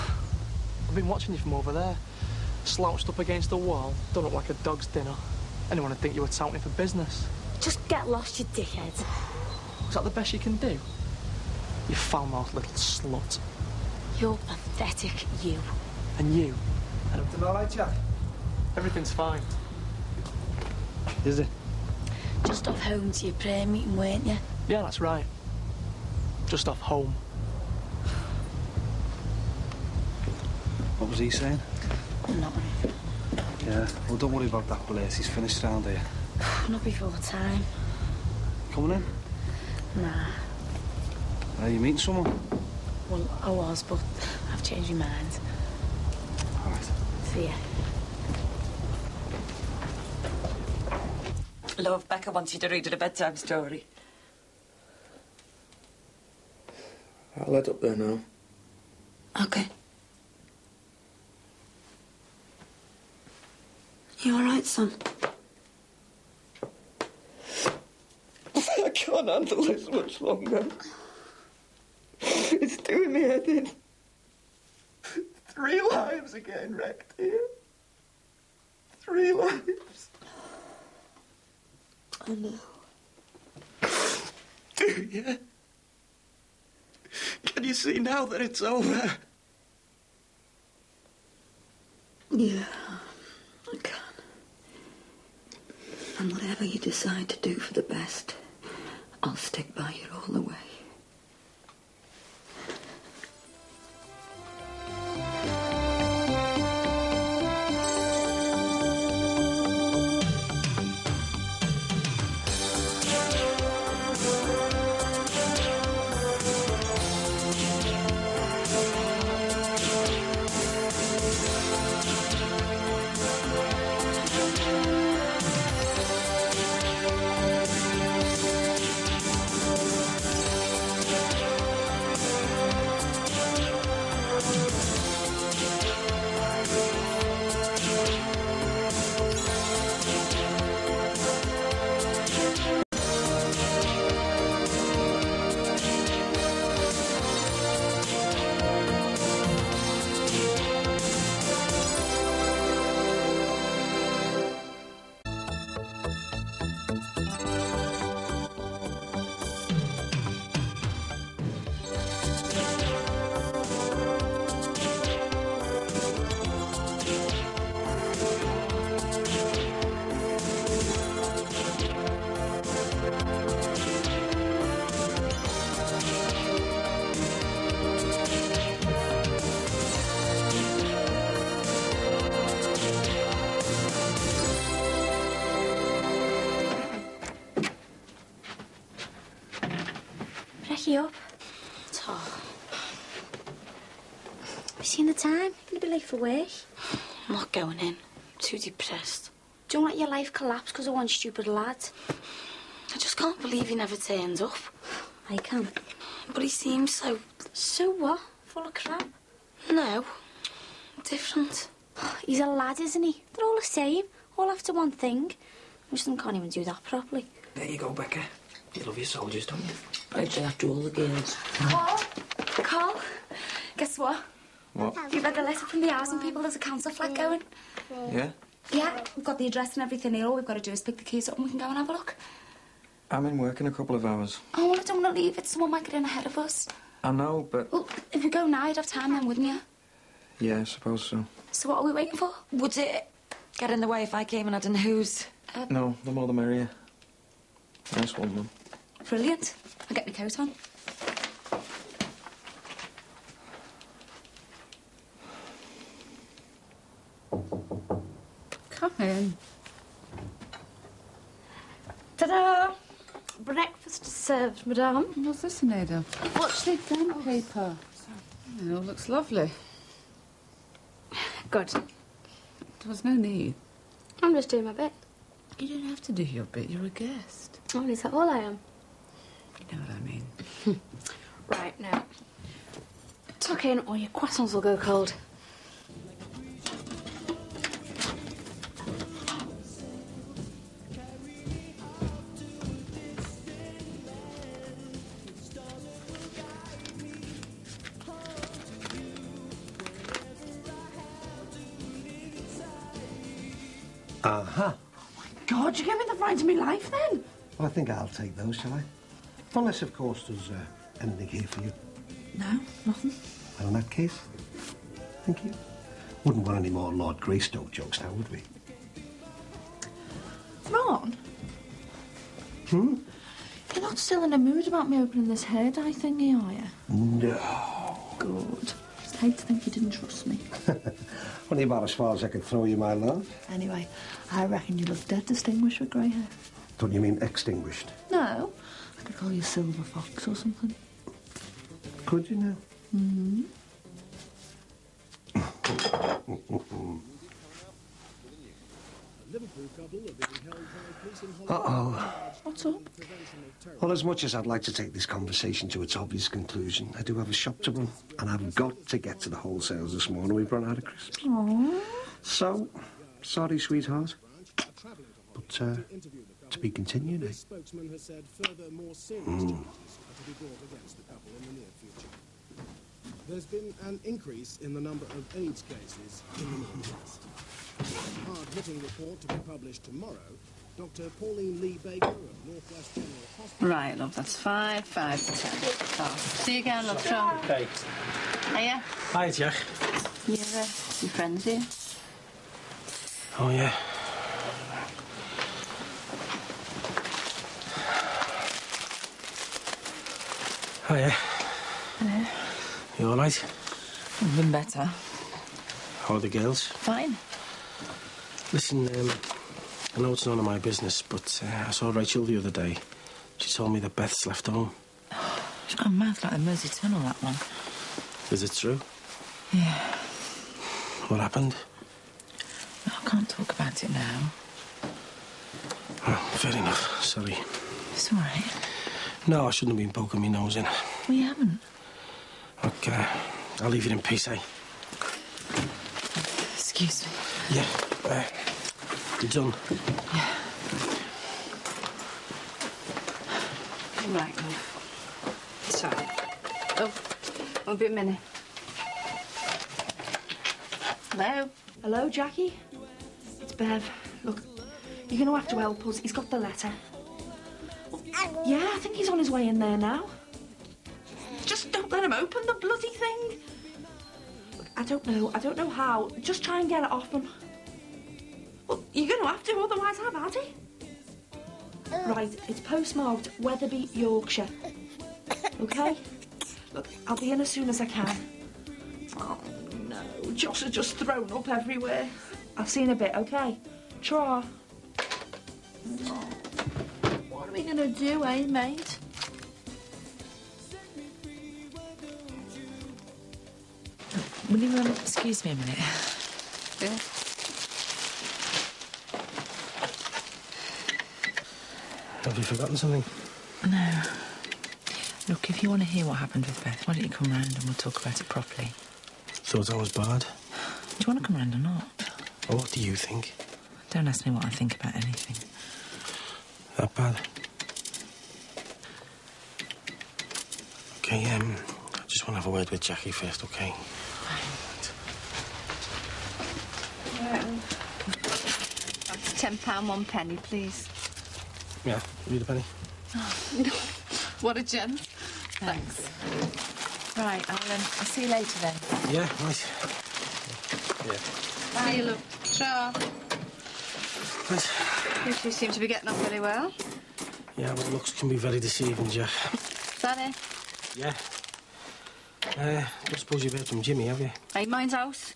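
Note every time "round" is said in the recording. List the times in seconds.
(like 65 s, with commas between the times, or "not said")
35 s, 507 s, 511 s.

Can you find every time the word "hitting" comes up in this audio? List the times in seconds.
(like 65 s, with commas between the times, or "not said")
378 s.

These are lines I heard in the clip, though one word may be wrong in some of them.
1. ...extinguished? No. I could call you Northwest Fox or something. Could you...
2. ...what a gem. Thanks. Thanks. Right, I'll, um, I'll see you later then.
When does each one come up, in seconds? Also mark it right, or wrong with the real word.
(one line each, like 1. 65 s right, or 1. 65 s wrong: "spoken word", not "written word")
1. 337 s wrong: "Silver", not "Northwest"
2. 534 s right.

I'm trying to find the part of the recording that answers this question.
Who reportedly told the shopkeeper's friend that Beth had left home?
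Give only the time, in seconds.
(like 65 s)
411 s.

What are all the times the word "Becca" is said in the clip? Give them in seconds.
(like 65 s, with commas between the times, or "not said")
52 s, 217 s.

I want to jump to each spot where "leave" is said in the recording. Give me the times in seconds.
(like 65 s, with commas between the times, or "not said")
235 s, 433 s.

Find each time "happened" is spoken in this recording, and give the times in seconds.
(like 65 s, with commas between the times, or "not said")
421 s, 506 s.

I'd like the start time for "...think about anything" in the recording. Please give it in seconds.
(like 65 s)
514 s.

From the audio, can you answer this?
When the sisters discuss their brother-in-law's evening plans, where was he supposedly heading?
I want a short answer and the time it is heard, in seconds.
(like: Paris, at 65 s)
Prayer meeting, at 23 s.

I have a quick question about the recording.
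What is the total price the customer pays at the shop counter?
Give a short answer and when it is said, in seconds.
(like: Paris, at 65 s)
£10.01, at 529 s.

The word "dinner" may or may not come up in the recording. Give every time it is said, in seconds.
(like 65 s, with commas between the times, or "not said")
4 s.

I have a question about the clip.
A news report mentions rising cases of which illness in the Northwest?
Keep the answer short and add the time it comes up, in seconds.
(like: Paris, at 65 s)
AIDS, at 375 s.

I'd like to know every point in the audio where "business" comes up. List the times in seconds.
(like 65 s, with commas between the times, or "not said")
6 s, 410 s.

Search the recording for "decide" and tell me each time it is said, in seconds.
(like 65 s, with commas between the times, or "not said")
96 s.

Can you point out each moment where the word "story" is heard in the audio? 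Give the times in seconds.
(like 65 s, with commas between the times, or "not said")
53 s.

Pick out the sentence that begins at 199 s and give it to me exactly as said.
Don't let your life collapse because of one stupid lad.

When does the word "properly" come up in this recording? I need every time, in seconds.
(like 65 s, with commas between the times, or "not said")
216 s, 508 s.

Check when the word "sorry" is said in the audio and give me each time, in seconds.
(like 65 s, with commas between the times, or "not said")
267 s, 363 s, 427 s.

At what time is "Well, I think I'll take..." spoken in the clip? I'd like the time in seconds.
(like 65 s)
307 s.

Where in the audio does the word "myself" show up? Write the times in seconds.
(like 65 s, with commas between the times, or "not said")
not said.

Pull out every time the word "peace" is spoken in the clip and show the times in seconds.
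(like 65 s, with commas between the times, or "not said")
434 s.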